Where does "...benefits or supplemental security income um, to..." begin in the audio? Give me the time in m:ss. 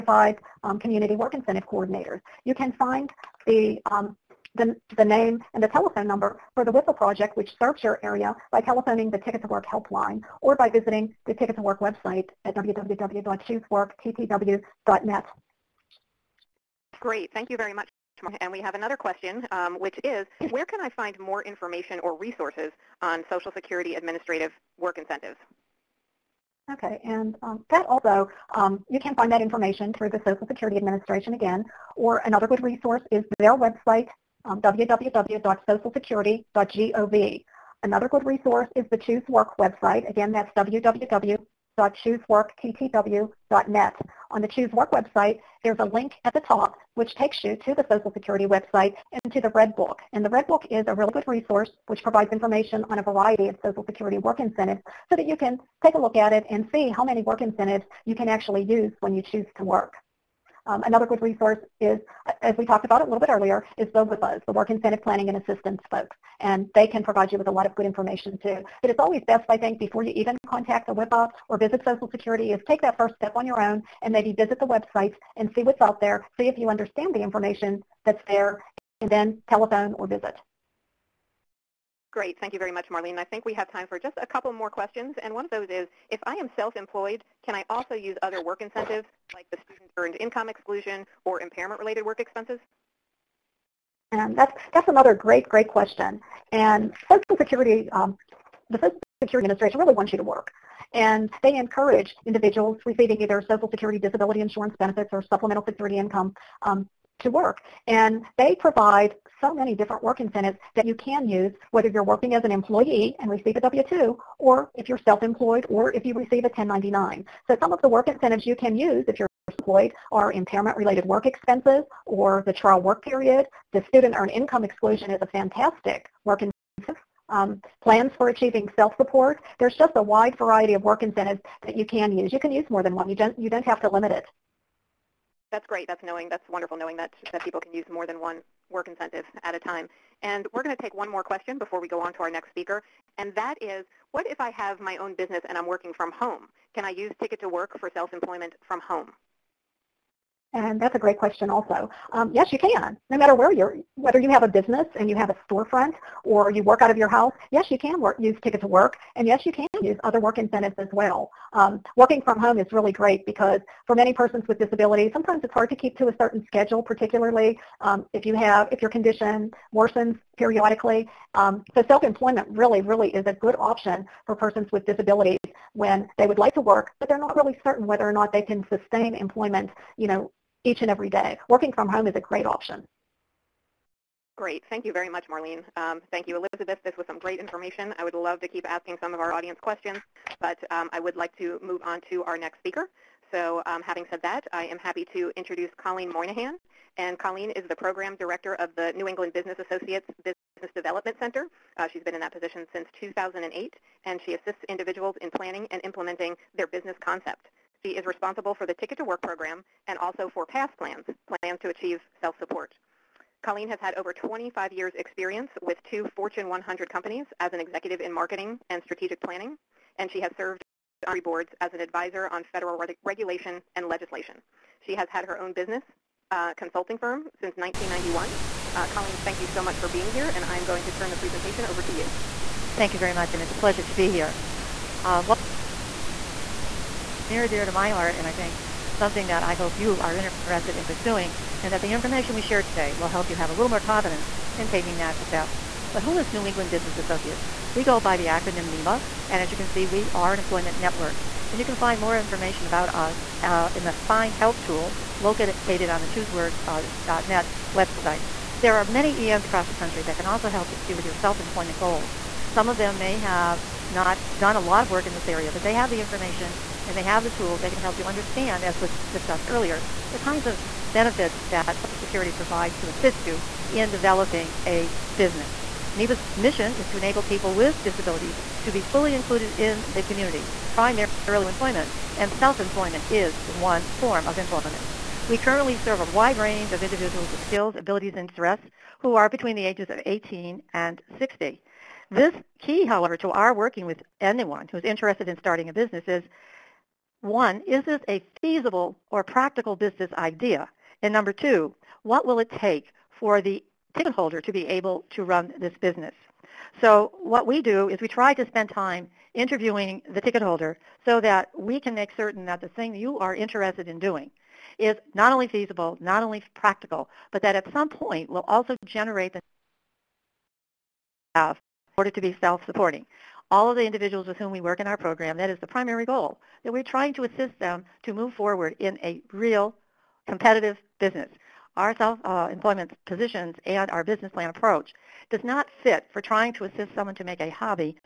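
1:44.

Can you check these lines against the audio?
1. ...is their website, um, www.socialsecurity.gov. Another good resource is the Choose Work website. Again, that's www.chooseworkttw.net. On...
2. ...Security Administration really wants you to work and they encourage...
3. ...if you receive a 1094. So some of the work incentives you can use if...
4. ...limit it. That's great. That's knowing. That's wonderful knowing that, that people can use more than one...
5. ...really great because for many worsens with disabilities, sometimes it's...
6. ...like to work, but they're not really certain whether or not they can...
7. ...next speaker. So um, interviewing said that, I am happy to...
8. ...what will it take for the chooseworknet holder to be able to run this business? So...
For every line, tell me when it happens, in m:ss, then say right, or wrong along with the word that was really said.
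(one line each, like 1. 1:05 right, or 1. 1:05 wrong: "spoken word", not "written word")
1. 0:33 right
2. 1:39 right
3. 1:55 wrong: "1099", not "1094"
4. 2:13 right
5. 2:42 wrong: "persons", not "worsens"
6. 2:56 right
7. 3:12 wrong: "having", not "interviewing"
8. 5:02 wrong: "ticket", not "chooseworknet".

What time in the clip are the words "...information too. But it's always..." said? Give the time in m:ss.
1:07.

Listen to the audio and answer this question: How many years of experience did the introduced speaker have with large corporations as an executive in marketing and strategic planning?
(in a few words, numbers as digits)
25.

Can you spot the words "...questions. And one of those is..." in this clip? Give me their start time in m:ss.
1:24.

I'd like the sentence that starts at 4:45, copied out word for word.
We currently serve a wide range of individuals with skills, abilities, and interests who are between the ages of 18 and 60.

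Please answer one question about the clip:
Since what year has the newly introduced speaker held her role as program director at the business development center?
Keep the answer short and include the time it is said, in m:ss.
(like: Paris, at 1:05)
2008, at 3:23.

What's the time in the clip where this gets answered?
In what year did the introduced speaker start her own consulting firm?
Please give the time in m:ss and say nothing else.
3:47.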